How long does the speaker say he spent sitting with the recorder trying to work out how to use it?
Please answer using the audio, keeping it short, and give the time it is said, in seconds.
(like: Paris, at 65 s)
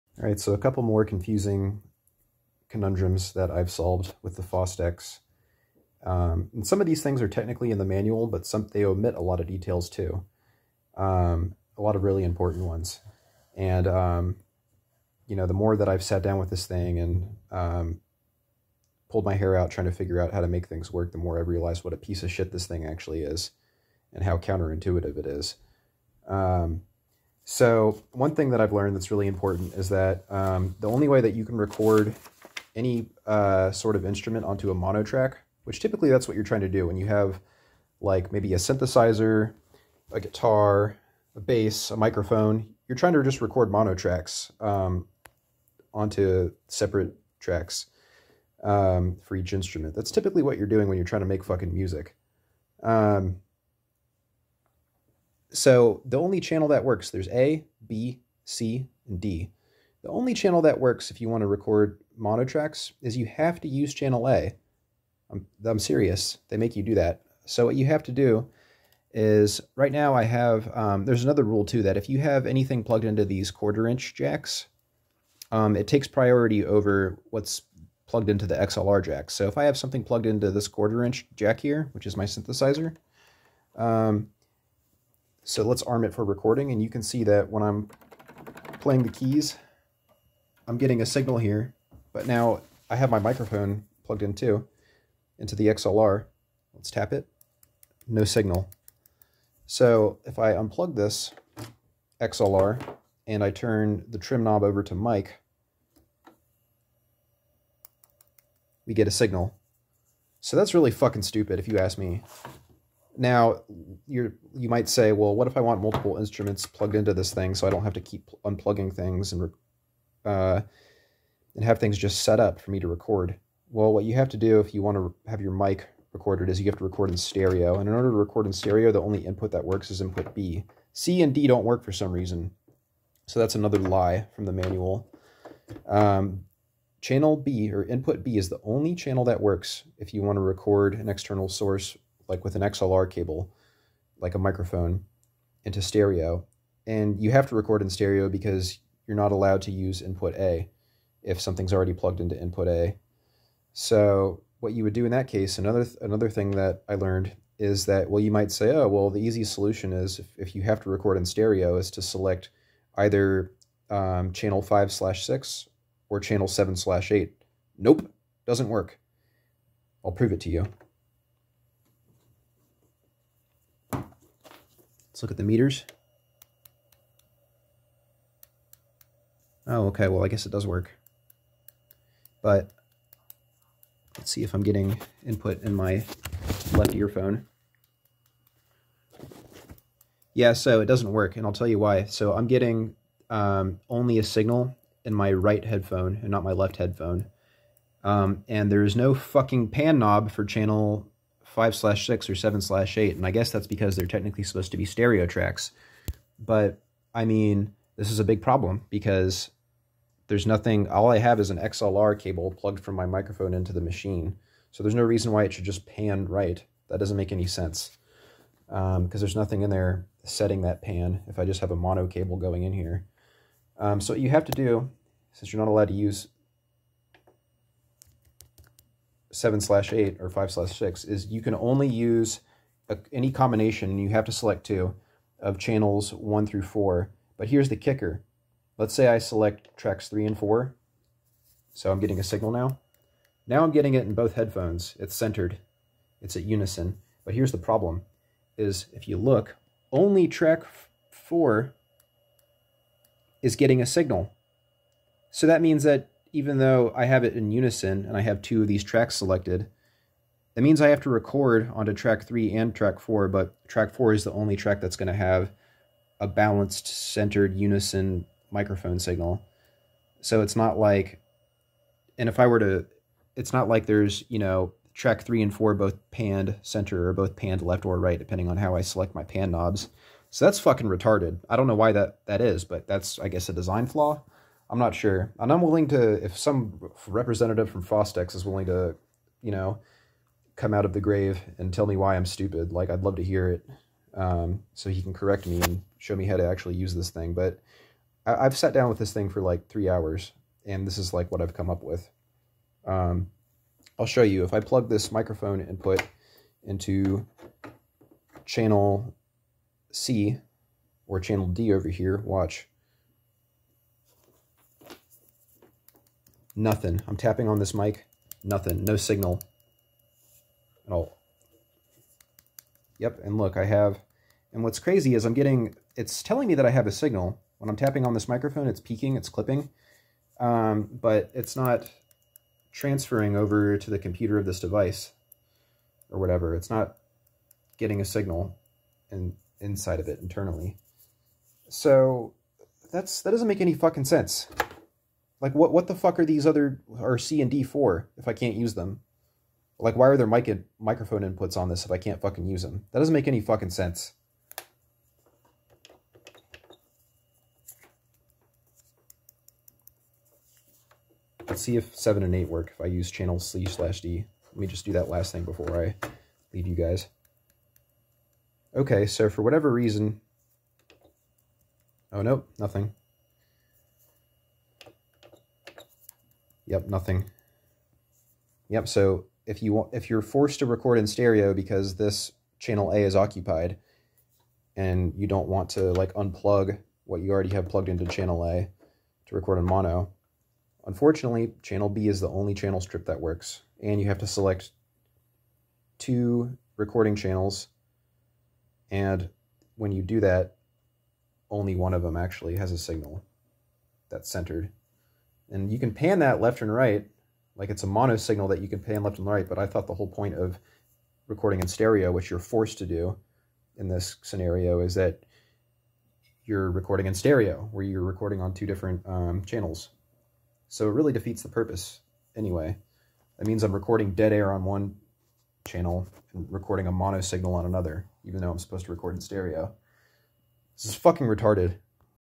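3 hours, at 299 s.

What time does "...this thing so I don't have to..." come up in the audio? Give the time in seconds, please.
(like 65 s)
117 s.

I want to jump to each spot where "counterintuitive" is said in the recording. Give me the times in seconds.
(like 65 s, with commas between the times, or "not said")
24 s.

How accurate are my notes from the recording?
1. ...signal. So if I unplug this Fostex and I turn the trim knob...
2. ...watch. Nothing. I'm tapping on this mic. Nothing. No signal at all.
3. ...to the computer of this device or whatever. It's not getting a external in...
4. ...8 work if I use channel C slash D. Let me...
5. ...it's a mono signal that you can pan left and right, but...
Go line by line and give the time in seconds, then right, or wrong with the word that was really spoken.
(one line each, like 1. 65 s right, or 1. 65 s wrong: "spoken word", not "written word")
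1. 98 s wrong: "XLR", not "Fostex"
2. 312 s right
3. 333 s wrong: "signal", not "external"
4. 362 s right
5. 407 s right.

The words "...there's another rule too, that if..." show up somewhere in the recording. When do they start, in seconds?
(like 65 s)
71 s.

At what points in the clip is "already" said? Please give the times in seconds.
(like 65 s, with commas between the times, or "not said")
151 s, 387 s.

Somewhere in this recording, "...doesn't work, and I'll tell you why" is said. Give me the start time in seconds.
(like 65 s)
190 s.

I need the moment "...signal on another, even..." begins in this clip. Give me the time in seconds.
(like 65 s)
427 s.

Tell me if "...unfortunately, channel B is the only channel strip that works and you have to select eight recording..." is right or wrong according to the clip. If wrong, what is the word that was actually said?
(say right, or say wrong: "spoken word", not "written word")
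wrong: "two", not "eight".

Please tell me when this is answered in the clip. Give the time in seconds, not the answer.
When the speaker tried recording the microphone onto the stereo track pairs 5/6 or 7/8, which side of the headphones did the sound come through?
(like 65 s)
195 s.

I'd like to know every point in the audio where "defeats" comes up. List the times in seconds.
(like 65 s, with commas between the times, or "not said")
421 s.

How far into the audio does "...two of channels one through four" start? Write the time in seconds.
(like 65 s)
234 s.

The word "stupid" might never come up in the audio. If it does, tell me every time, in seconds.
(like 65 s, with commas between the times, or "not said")
111 s, 292 s.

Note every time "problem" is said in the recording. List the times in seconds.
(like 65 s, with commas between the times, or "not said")
208 s, 247 s.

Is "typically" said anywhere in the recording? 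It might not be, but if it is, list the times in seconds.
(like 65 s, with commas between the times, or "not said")
35 s, 50 s.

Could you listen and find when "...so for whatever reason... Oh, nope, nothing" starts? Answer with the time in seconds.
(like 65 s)
369 s.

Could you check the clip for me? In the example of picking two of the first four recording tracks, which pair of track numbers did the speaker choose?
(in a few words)
3 and 4.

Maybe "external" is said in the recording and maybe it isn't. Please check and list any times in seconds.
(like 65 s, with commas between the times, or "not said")
141 s.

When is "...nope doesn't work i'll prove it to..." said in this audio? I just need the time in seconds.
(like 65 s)
167 s.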